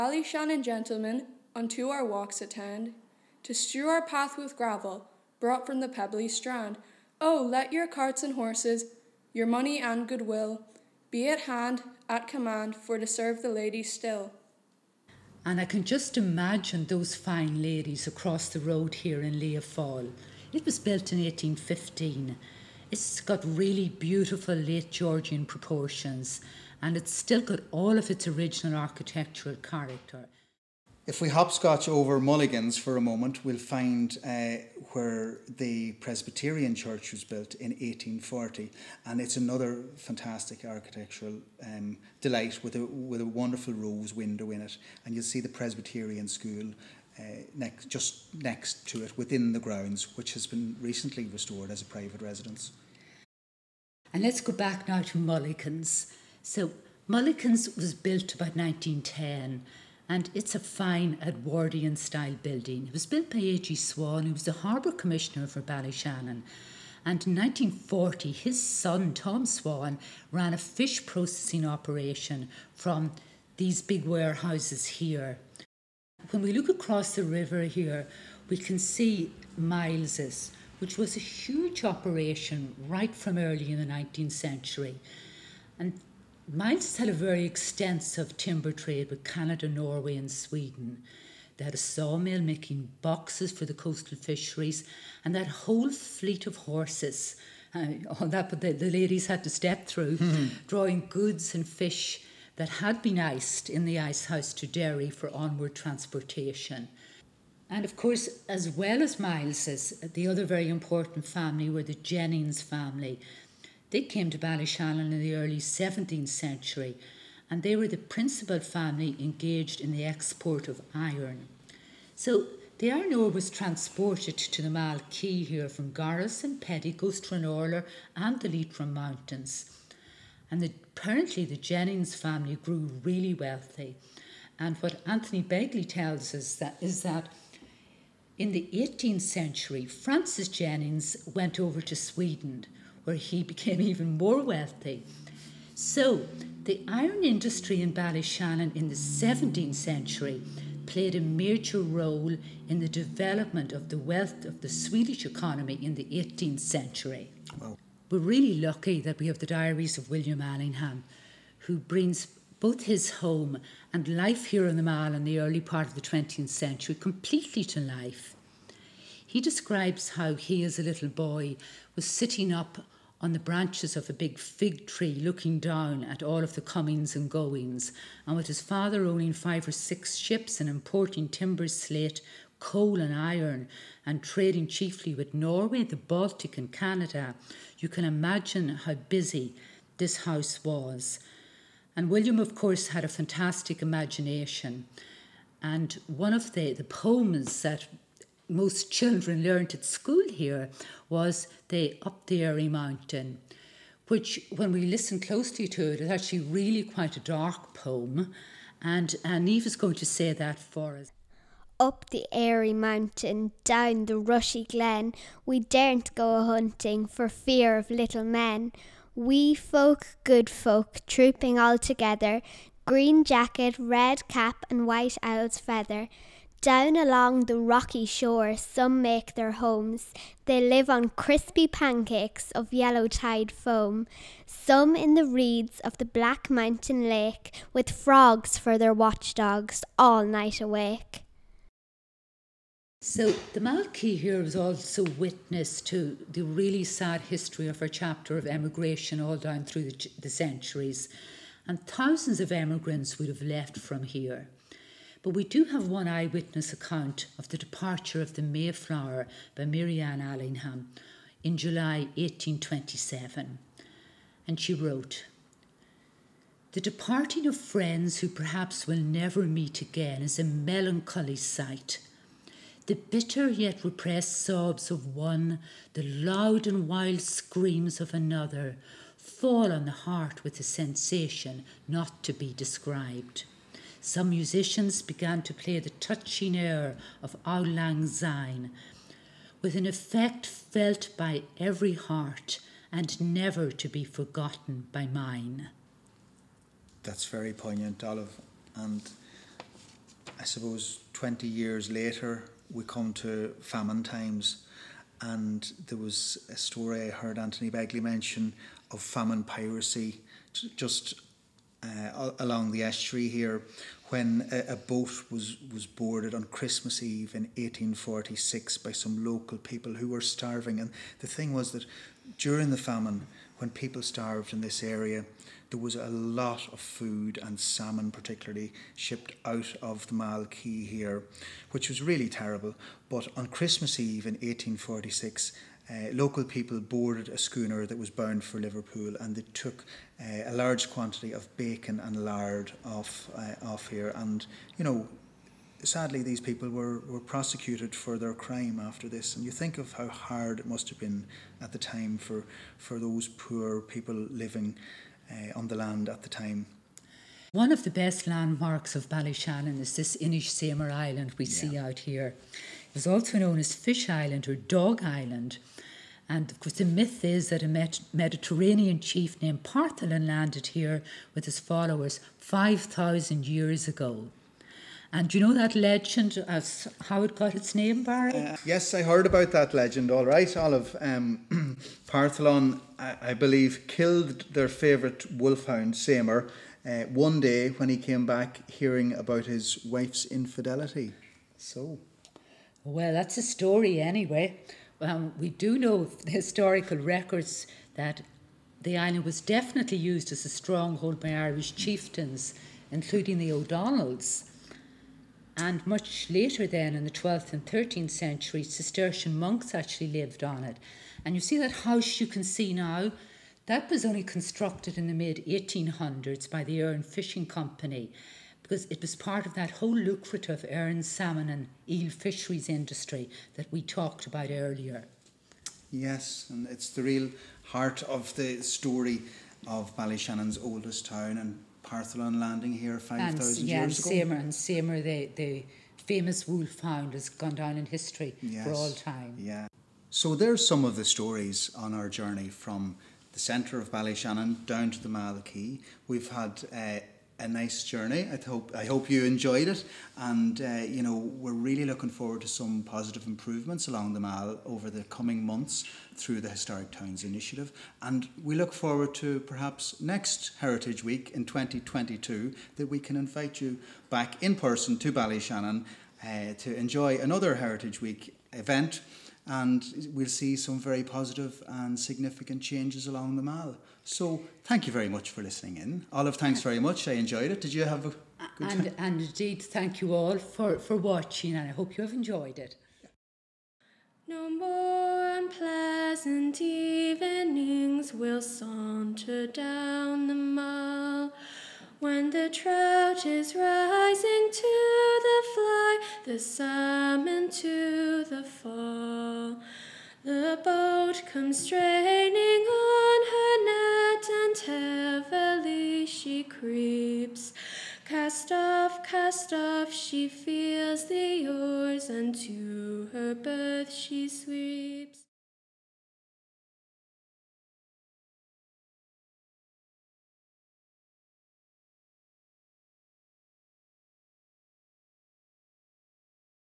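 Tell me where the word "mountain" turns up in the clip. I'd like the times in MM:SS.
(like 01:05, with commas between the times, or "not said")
02:08, 03:22, 03:32, 03:56.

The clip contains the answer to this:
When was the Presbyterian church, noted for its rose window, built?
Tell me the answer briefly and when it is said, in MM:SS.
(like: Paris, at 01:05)
1840, at 00:37.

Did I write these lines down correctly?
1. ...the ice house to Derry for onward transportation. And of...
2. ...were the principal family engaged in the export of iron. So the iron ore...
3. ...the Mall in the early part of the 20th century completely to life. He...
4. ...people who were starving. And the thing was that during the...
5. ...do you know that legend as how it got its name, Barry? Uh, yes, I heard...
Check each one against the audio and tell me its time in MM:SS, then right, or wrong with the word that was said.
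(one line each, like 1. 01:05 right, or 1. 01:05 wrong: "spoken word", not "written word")
1. 01:43 right
2. 01:57 right
3. 02:44 right
4. 05:19 right
5. 06:15 right.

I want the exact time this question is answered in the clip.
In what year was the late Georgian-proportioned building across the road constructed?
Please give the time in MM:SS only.
00:21.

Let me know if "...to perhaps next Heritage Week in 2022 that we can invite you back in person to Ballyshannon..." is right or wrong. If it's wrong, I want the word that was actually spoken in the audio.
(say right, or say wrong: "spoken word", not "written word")
right.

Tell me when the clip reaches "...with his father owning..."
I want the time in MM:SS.
02:58.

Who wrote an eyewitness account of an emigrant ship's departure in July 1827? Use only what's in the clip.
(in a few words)
Marianne Allingham.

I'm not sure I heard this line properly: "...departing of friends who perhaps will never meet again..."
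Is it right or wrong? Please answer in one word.
right.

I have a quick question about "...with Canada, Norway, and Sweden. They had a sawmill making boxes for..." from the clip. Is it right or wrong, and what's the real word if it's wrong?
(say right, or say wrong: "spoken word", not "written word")
right.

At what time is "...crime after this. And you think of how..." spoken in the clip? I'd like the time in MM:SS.
05:48.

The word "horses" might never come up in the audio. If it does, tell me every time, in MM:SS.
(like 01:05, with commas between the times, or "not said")
00:08, 01:36.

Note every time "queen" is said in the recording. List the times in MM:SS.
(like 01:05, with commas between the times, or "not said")
not said.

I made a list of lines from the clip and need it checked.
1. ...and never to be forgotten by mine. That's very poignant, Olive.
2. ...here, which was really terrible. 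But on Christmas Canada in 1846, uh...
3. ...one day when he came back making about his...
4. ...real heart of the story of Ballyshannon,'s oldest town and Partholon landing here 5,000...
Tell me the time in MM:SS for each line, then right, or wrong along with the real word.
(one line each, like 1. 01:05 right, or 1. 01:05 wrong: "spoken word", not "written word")
1. 04:52 right
2. 05:30 wrong: "Eve", not "Canada"
3. 06:27 wrong: "hearing", not "making"
4. 07:07 right.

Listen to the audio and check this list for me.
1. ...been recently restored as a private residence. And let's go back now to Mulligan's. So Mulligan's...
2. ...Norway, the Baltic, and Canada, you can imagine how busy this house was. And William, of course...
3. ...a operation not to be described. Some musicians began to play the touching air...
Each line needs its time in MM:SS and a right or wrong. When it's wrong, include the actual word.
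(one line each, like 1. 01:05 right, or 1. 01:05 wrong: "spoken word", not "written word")
1. 00:50 right
2. 03:05 right
3. 04:40 wrong: "sensation", not "operation".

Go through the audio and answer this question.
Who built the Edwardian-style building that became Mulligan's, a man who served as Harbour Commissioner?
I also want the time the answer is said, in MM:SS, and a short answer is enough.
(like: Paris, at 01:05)
A.G. Swan, at 01:03.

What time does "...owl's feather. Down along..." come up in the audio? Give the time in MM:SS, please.
03:45.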